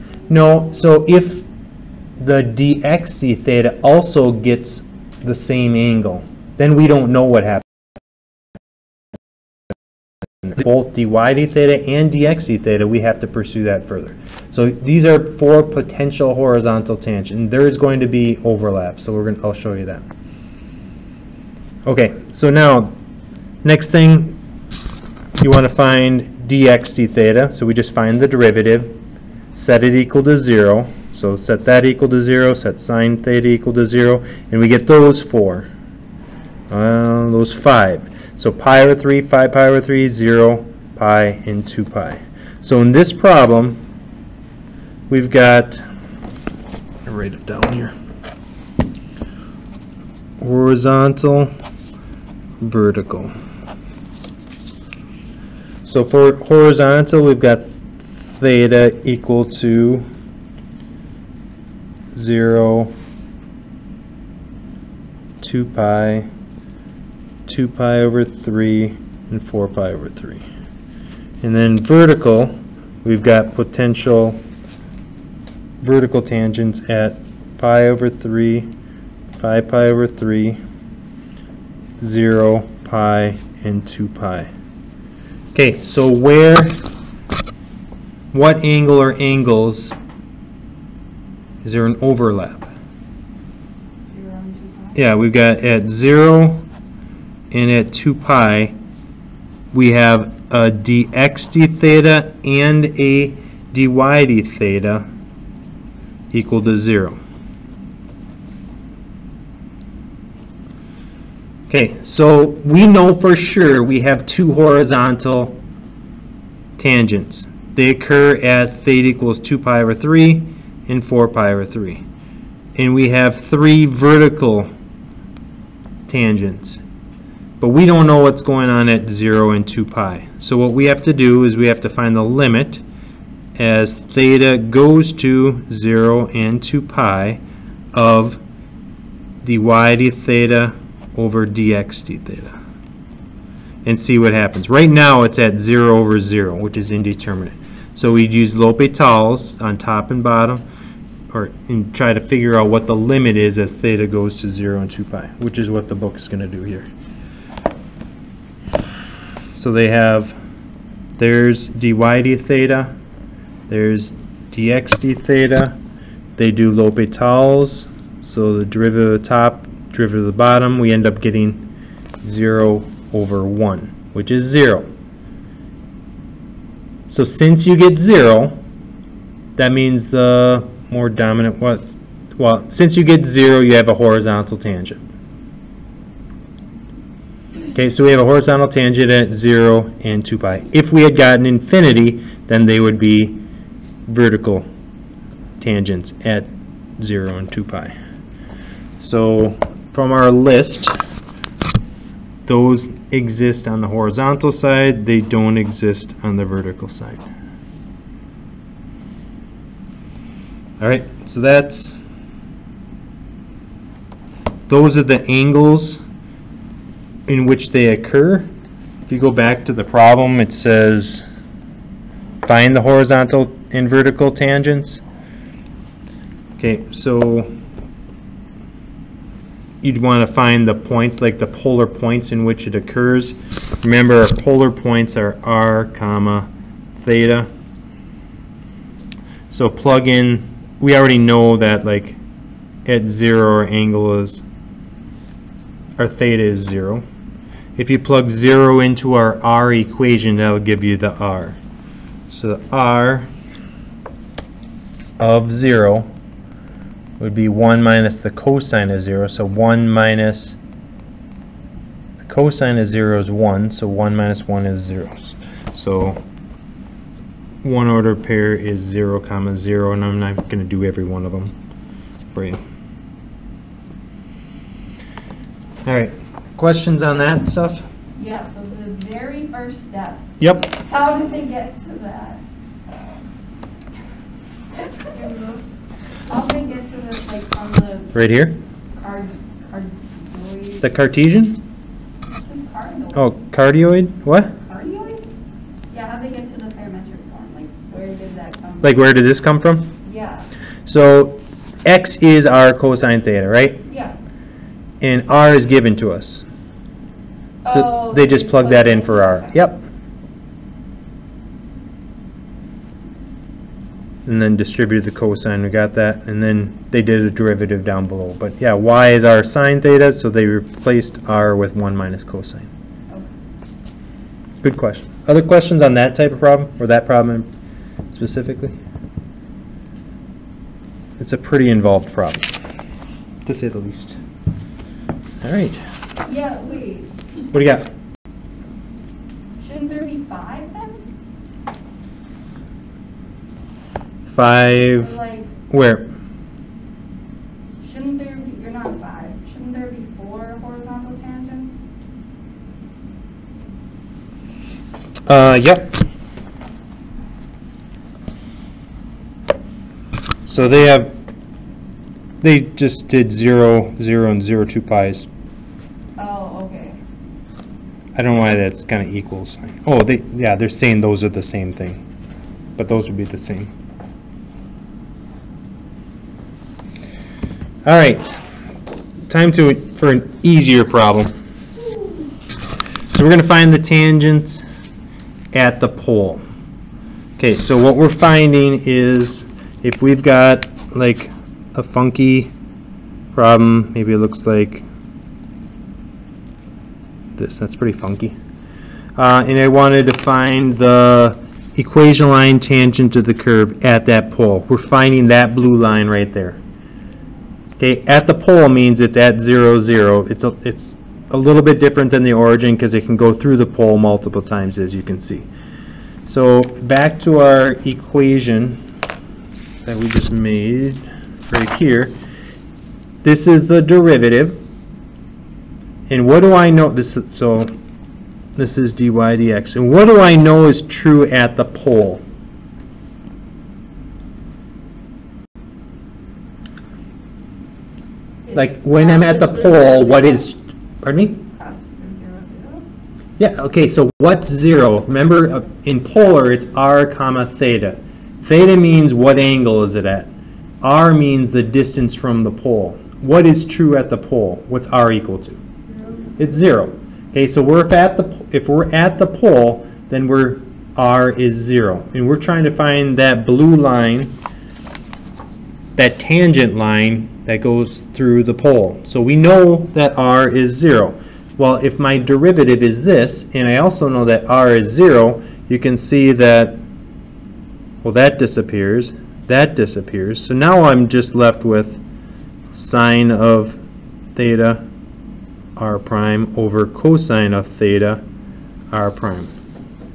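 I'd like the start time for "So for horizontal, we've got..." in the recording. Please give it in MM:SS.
00:55.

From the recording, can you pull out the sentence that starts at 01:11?
And then vertical, we've got potential vertical tangents at pi over 3, 5 pi over 3, 0, pi, and 2 pi.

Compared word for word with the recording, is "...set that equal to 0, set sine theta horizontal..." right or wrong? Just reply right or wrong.
wrong.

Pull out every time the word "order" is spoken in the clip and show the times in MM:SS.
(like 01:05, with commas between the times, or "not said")
04:27.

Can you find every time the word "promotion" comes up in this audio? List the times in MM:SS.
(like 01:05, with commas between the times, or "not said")
not said.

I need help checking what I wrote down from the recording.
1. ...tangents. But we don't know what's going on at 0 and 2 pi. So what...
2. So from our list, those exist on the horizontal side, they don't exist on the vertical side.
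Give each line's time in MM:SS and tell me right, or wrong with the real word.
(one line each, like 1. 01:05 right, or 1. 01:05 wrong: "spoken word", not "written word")
1. 02:06 right
2. 03:19 right.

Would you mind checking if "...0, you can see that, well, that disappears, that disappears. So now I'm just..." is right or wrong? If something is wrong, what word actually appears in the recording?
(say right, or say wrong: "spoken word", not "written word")
right.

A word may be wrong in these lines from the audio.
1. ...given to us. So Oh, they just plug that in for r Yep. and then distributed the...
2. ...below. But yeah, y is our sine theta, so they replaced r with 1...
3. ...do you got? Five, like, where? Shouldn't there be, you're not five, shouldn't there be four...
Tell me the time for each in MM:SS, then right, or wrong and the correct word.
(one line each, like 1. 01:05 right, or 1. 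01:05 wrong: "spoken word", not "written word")
1. 05:05 right
2. 05:18 right
3. 05:37 right.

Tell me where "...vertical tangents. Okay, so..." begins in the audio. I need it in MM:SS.
03:43.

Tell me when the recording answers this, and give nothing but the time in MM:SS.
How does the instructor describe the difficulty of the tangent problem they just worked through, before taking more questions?
05:31.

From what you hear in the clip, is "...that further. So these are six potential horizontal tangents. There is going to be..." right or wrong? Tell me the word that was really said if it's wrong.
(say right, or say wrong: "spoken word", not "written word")
wrong: "four", not "six".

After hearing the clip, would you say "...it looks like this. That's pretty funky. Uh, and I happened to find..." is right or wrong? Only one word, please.
wrong.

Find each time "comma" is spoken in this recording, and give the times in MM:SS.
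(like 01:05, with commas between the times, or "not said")
03:55, 04:29, 07:27.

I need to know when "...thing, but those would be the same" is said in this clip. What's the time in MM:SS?
06:11.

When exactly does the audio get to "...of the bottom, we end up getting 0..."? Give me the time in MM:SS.
02:50.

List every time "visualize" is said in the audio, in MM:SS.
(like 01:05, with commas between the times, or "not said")
not said.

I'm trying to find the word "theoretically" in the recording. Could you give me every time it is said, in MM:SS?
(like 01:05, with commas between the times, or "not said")
not said.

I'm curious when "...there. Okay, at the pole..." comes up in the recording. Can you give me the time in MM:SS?
06:46.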